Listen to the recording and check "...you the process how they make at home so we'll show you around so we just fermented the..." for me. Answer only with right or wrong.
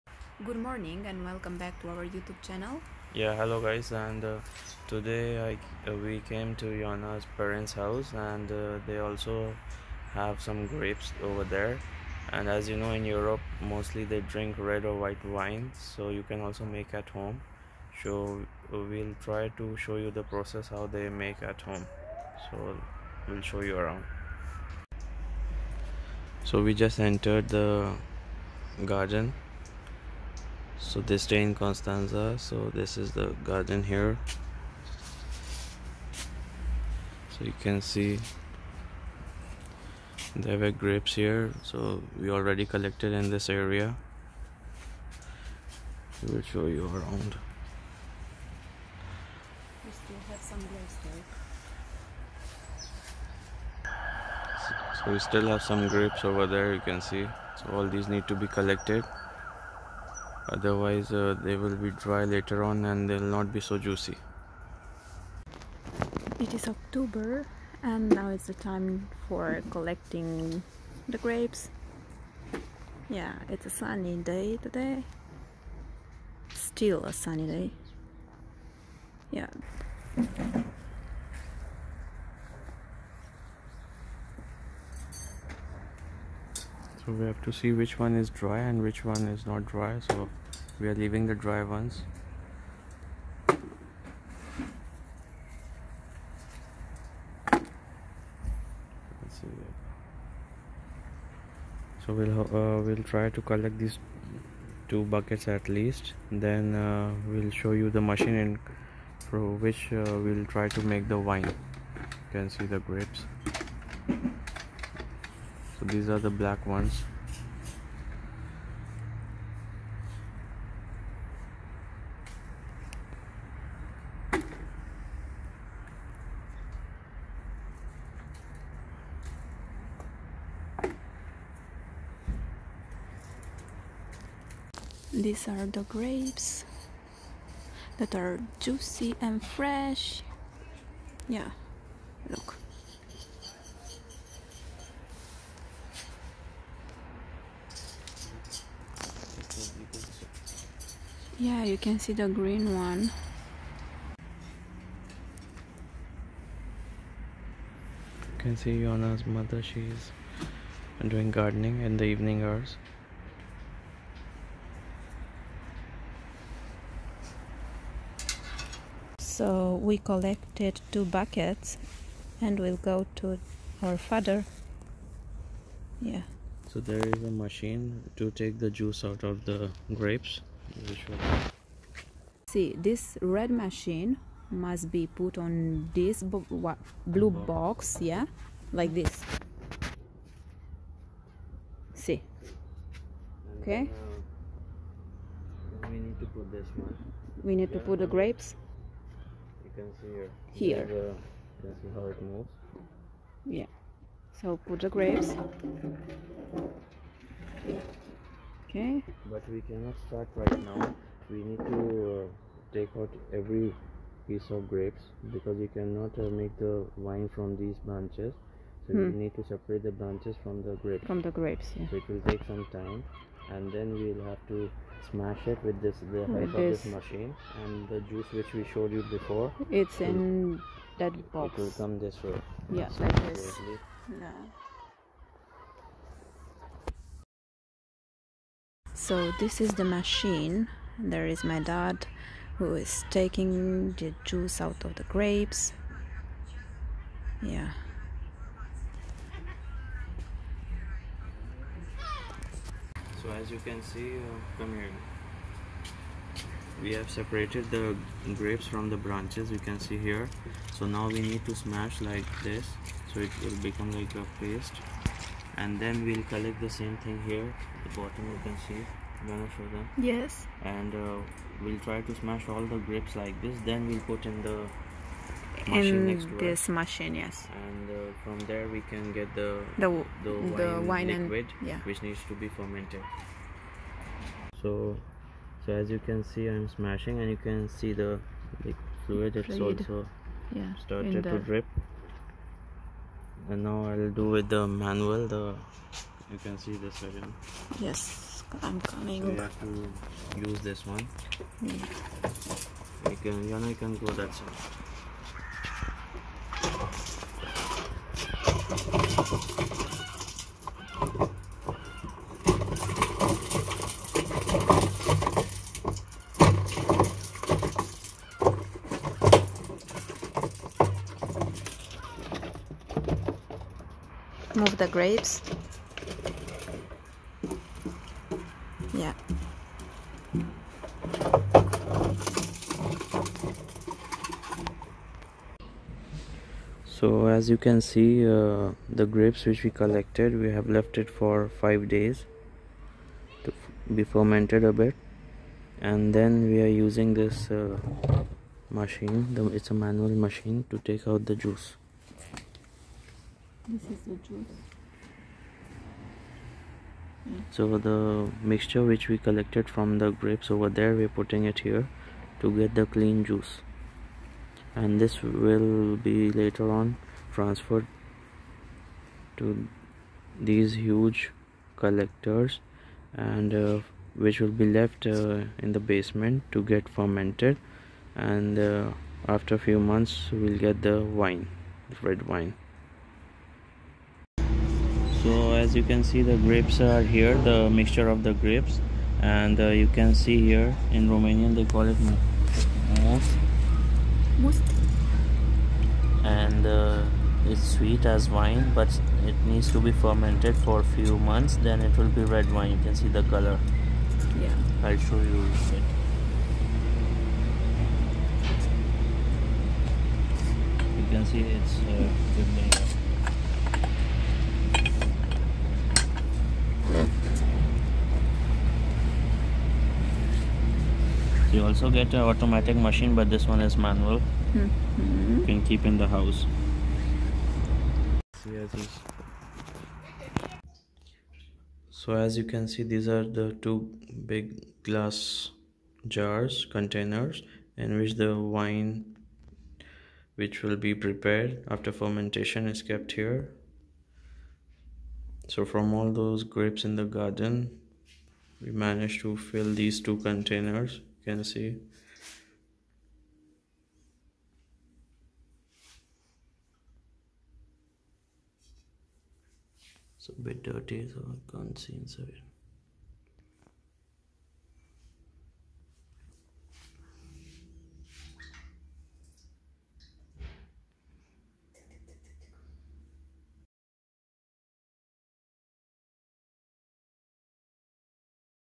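wrong.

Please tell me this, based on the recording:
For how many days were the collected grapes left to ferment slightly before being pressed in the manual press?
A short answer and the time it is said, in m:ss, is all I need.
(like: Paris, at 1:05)
5, at 5:41.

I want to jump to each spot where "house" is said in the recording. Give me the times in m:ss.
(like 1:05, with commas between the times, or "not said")
0:07, 7:06.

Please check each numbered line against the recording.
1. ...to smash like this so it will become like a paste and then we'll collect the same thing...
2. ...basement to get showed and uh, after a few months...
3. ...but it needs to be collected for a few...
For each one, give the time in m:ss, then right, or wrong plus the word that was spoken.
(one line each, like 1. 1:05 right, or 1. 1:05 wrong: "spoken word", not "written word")
1. 4:21 right
2. 6:15 wrong: "fermented", not "showed"
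3. 6:38 wrong: "fermented", not "collected".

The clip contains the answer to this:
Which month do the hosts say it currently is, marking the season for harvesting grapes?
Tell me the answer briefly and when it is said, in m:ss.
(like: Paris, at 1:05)
October, at 1:06.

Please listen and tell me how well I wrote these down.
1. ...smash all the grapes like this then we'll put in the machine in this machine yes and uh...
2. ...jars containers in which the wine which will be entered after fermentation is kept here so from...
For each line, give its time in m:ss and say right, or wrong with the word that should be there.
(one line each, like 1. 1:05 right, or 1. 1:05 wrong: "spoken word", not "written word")
1. 4:32 right
2. 7:16 wrong: "prepared", not "entered".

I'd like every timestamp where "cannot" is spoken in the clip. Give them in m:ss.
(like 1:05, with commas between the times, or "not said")
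3:29, 3:35.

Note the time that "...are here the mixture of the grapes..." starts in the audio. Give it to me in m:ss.
6:26.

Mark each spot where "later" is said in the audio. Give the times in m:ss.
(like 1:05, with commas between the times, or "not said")
1:02, 6:06.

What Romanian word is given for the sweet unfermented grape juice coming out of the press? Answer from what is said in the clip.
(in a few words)
most.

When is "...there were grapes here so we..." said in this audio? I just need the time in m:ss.
0:40.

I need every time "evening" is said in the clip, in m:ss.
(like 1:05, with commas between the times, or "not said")
2:42.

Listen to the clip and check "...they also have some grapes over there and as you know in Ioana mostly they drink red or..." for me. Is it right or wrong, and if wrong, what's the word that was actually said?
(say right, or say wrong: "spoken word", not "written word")
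wrong: "Europe", not "Ioana".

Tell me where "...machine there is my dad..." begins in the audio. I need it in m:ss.
3:59.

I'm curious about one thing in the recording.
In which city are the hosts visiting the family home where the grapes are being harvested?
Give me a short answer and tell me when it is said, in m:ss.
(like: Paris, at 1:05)
Constanta, at 0:31.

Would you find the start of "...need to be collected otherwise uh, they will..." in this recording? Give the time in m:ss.
0:58.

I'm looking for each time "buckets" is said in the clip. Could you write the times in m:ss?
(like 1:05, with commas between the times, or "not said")
1:45, 2:51.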